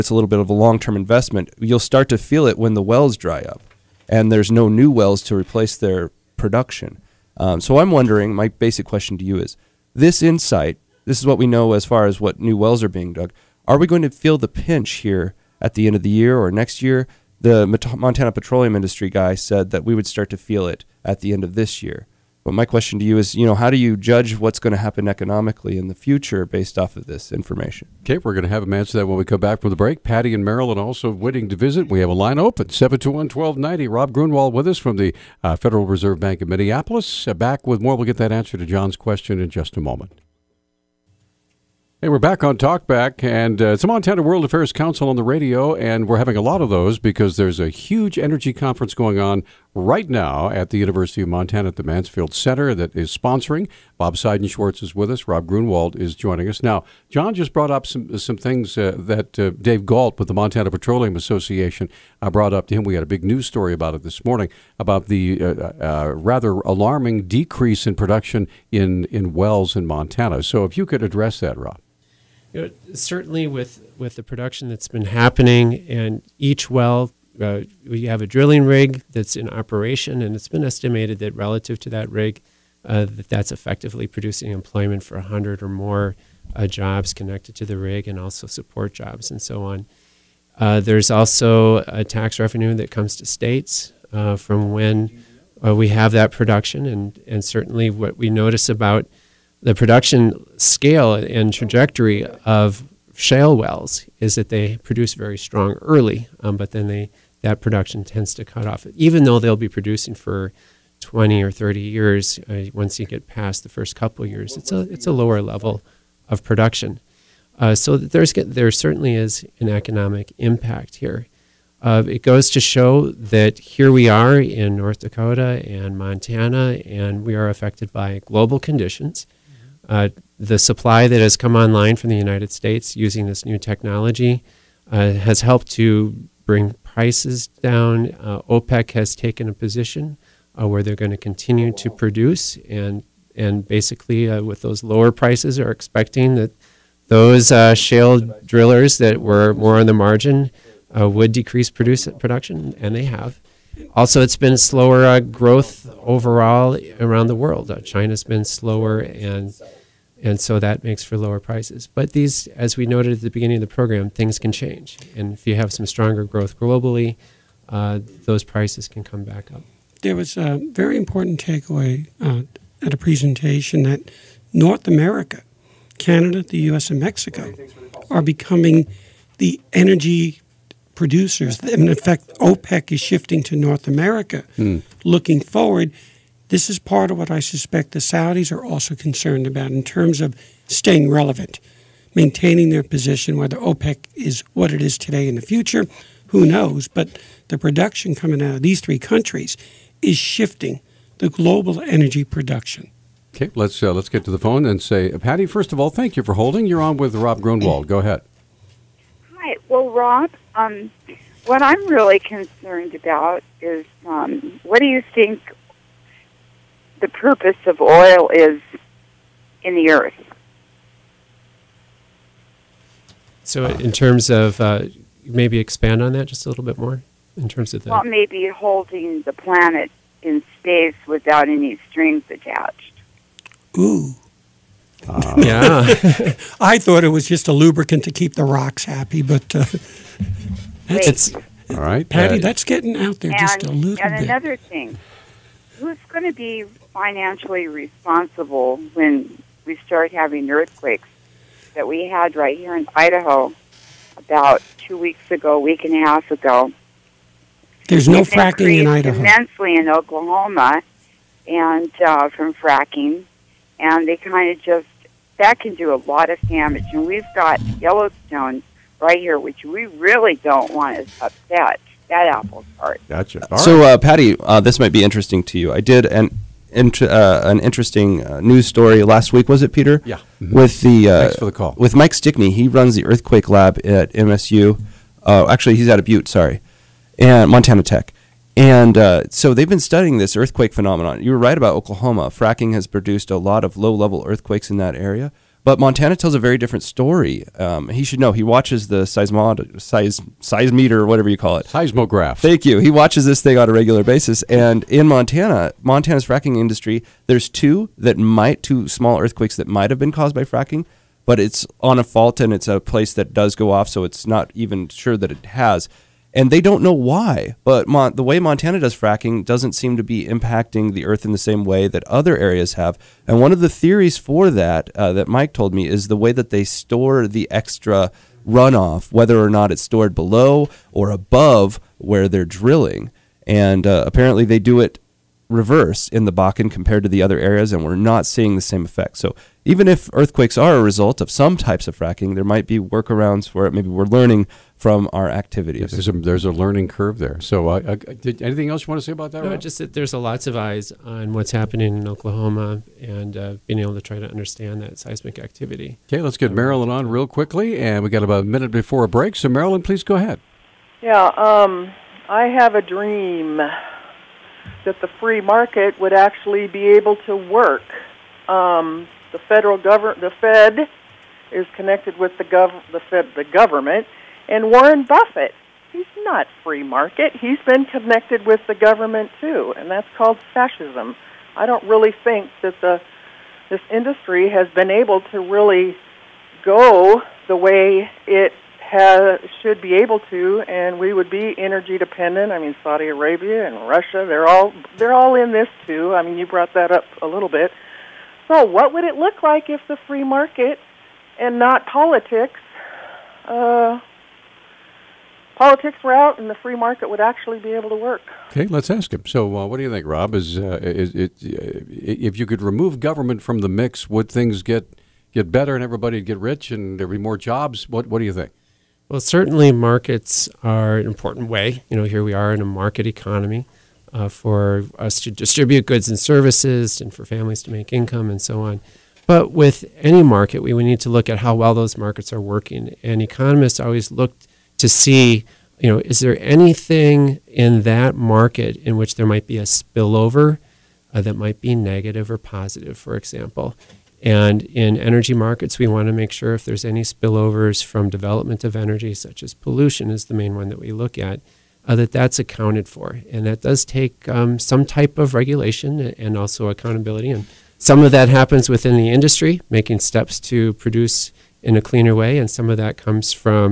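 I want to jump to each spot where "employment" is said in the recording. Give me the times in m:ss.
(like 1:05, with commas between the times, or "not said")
1:24.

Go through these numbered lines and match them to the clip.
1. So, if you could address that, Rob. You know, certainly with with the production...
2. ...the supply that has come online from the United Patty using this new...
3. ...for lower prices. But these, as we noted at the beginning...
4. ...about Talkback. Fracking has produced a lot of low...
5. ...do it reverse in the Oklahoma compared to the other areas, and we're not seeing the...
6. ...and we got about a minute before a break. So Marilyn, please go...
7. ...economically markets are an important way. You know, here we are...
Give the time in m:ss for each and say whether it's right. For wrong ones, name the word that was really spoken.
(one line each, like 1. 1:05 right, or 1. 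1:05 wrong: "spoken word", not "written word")
1. 1:10 right
2. 2:10 wrong: "States", not "Patty"
3. 2:41 right
4. 4:51 wrong: "Oklahoma", not "Talkback"
5. 5:34 wrong: "Bakken", not "Oklahoma"
6. 5:57 right
7. 6:59 wrong: "certainly", not "economically".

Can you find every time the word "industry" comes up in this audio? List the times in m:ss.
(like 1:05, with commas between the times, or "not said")
0:18, 5:06, 6:23, 7:39.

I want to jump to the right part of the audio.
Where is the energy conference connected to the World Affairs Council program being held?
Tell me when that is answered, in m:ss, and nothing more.
0:51.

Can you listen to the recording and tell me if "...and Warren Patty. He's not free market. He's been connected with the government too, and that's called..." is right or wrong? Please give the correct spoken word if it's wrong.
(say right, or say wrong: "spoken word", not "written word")
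wrong: "Buffett", not "Patty".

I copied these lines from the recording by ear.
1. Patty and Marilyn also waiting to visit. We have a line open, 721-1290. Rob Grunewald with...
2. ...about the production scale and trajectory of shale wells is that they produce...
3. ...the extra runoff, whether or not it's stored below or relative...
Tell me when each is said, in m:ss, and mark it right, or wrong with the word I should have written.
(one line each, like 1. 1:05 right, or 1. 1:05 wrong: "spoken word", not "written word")
1. 0:30 right
2. 1:38 right
3. 5:27 wrong: "above", not "relative".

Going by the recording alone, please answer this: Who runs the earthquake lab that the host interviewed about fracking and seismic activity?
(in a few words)
Mike Stickney.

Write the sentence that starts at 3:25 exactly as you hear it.
First of all, thank you for holding.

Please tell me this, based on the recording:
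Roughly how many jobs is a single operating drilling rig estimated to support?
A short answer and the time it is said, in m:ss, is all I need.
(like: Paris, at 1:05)
100, at 1:25.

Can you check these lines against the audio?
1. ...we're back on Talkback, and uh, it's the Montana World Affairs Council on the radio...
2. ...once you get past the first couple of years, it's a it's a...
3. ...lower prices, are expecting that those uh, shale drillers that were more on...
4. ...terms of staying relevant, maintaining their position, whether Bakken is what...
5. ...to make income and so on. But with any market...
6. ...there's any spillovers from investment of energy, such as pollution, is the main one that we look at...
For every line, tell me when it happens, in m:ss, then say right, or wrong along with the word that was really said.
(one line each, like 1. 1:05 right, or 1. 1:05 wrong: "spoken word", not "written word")
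1. 0:42 right
2. 1:52 right
3. 2:24 right
4. 3:09 wrong: "OPEC", not "Bakken"
5. 7:07 right
6. 7:26 wrong: "development", not "investment".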